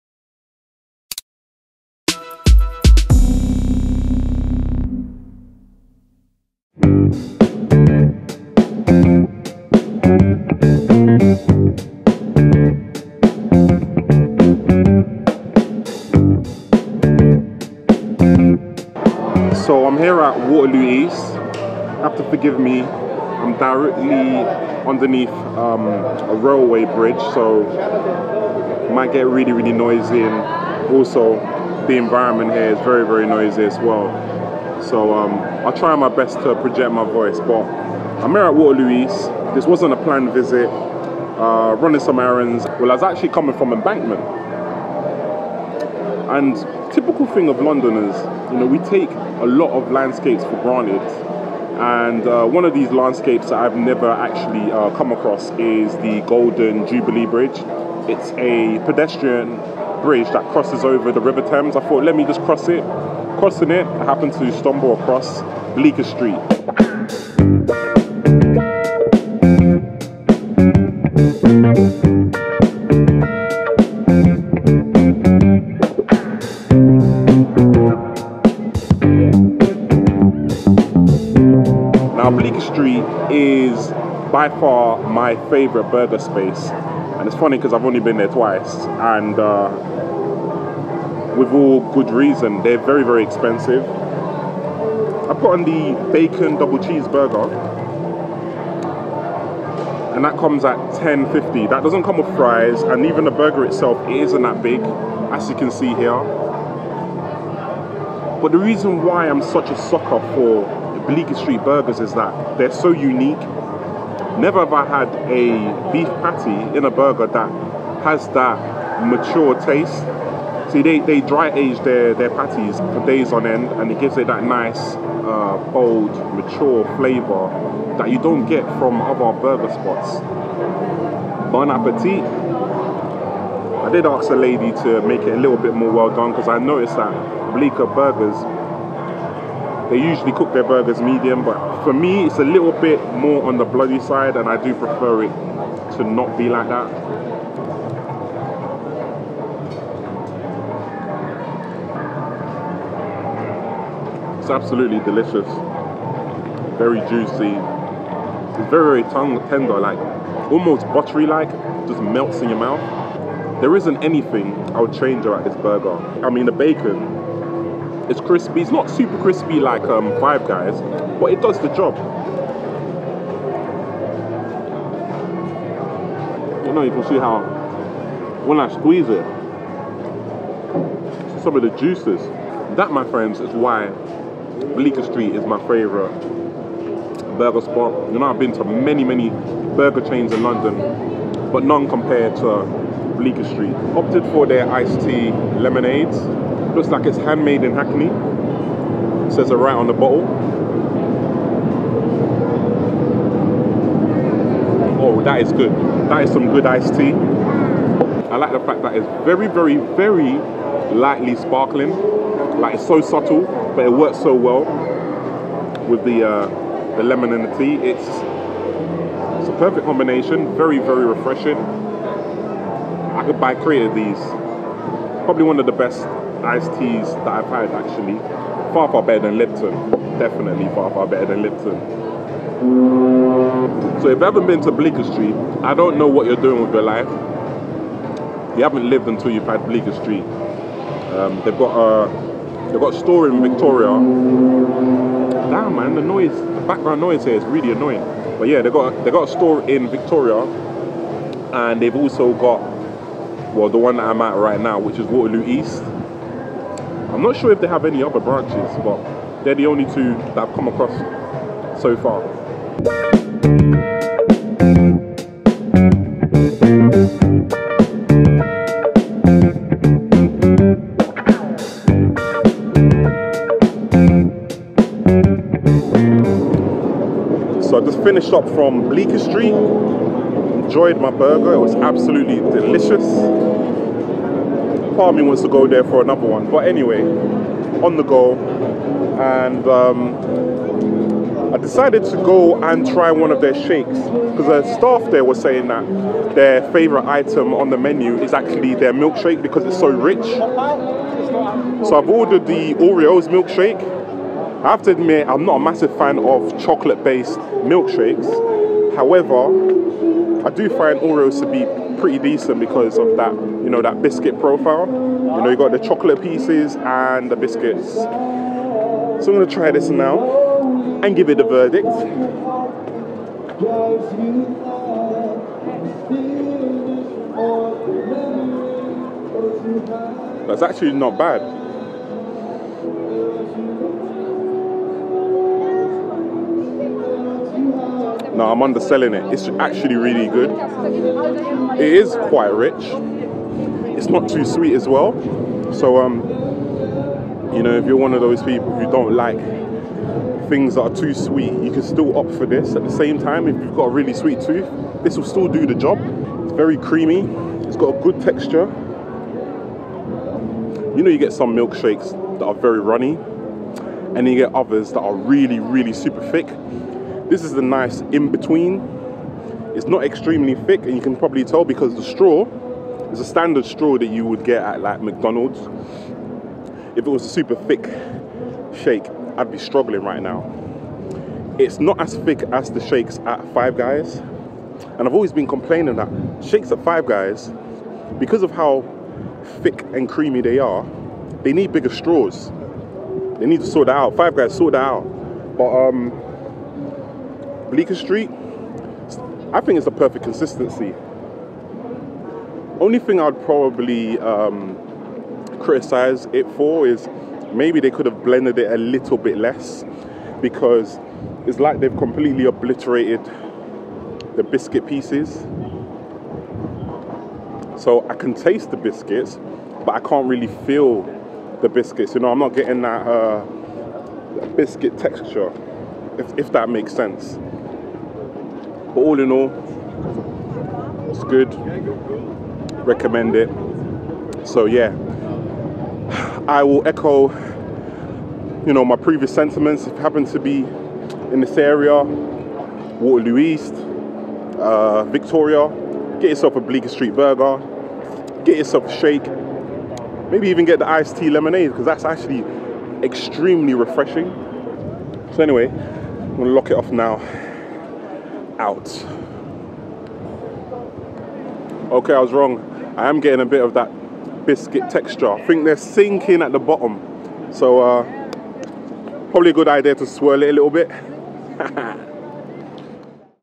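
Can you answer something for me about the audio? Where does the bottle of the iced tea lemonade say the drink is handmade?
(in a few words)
Hackney.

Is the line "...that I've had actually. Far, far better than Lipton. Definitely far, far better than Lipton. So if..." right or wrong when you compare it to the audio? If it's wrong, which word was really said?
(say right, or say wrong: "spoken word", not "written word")
right.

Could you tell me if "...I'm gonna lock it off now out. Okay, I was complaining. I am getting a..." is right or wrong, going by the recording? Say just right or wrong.
wrong.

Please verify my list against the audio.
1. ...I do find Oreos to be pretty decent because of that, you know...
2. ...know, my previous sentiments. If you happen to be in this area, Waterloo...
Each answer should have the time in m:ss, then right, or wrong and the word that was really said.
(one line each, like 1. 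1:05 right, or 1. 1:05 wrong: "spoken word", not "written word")
1. 5:10 right
2. 7:18 right.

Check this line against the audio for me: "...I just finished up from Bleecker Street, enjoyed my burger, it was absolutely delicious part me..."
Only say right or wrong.
right.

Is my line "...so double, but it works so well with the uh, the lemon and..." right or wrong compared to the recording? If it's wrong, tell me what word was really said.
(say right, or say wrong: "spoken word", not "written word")
wrong: "subtle", not "double".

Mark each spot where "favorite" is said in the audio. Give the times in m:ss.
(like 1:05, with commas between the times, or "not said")
1:25, 3:05, 4:56.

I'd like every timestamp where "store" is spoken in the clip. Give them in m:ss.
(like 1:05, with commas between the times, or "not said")
4:02, 4:09.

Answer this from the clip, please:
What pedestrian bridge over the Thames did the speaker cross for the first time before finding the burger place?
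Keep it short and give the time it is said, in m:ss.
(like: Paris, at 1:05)
Golden Jubilee Bridge, at 0:56.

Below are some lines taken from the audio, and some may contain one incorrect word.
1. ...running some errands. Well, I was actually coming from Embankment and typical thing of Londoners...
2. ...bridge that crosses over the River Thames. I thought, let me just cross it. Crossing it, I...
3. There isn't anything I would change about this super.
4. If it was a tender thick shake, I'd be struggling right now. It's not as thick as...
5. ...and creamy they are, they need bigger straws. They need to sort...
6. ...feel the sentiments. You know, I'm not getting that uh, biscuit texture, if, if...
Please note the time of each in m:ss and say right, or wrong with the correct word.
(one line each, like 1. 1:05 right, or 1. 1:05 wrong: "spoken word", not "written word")
1. 0:41 right
2. 1:00 right
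3. 2:43 wrong: "burger", not "super"
4. 6:16 wrong: "super", not "tender"
5. 6:29 right
6. 7:00 wrong: "biscuits", not "sentiments".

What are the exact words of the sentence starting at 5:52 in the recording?
At the same time, if you've got a really sweet tooth, this will still do the job.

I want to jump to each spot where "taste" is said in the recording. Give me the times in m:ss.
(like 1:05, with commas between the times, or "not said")
1:59, 6:58.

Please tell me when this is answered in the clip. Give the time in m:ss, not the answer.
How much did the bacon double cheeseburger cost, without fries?
1:41.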